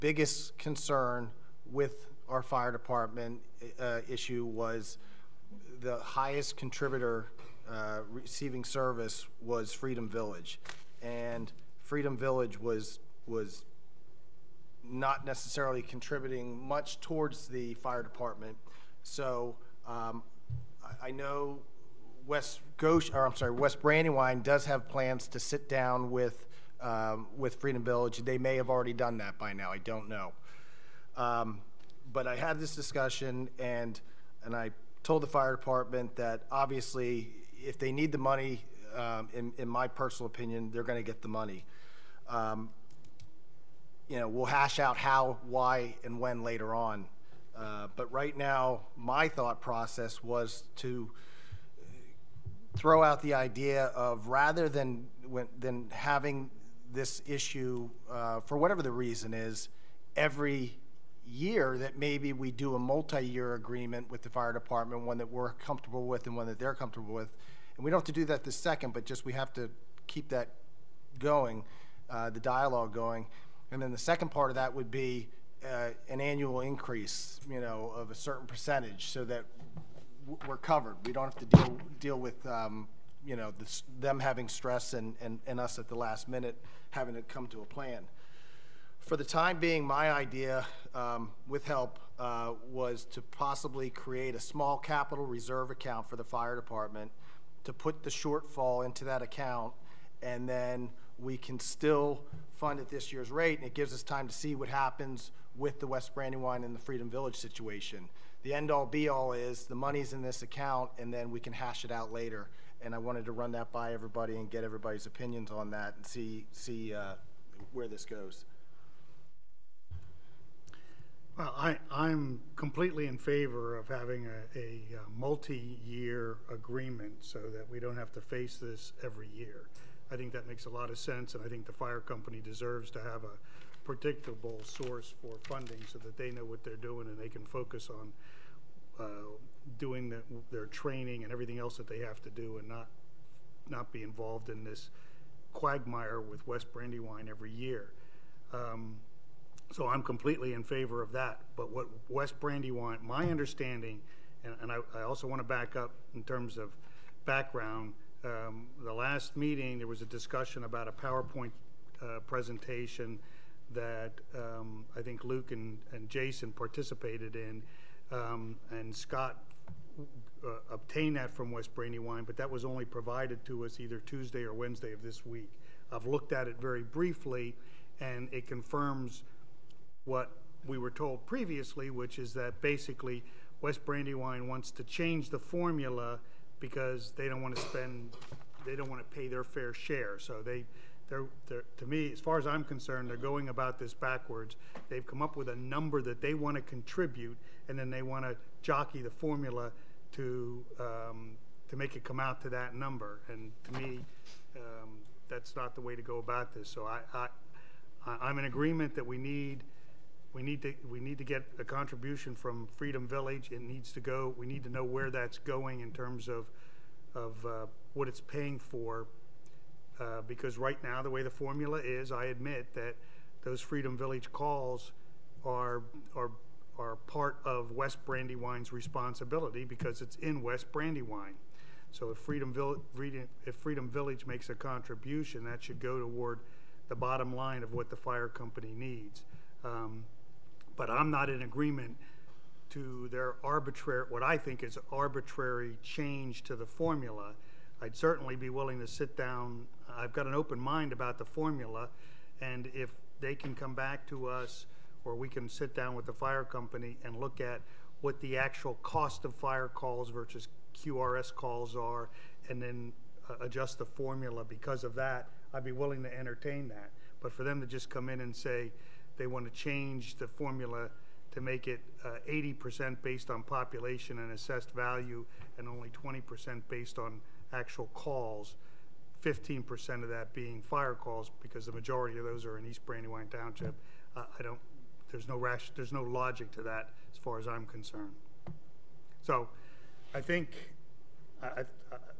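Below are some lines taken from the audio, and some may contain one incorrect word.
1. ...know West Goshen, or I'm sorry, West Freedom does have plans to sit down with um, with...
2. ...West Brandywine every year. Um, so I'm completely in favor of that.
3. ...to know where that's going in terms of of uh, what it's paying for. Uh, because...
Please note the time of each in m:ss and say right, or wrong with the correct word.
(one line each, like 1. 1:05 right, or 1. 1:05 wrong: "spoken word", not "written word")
1. 0:21 wrong: "Brandywine", not "Freedom"
2. 2:26 right
3. 3:34 right.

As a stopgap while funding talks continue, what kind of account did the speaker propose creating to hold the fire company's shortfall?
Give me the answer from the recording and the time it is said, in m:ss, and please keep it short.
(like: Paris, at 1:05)
capital reserve account, at 1:34.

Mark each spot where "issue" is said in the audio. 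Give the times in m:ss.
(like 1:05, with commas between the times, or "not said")
0:04, 0:57.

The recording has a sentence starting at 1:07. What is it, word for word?
And we don't have to do that this second, but just we have to keep that going.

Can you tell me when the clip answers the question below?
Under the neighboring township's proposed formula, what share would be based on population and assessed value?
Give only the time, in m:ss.
4:32.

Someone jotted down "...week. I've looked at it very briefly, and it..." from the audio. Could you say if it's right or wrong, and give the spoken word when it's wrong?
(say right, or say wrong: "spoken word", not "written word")
right.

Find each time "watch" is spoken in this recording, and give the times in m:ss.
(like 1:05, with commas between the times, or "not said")
not said.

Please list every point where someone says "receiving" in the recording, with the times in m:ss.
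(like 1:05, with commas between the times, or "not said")
0:08.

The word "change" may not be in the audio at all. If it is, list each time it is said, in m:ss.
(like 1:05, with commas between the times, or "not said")
3:04, 4:05, 4:29.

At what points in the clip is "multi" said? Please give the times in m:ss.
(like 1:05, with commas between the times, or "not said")
1:02, 2:05.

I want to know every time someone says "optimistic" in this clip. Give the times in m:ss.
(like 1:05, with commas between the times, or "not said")
not said.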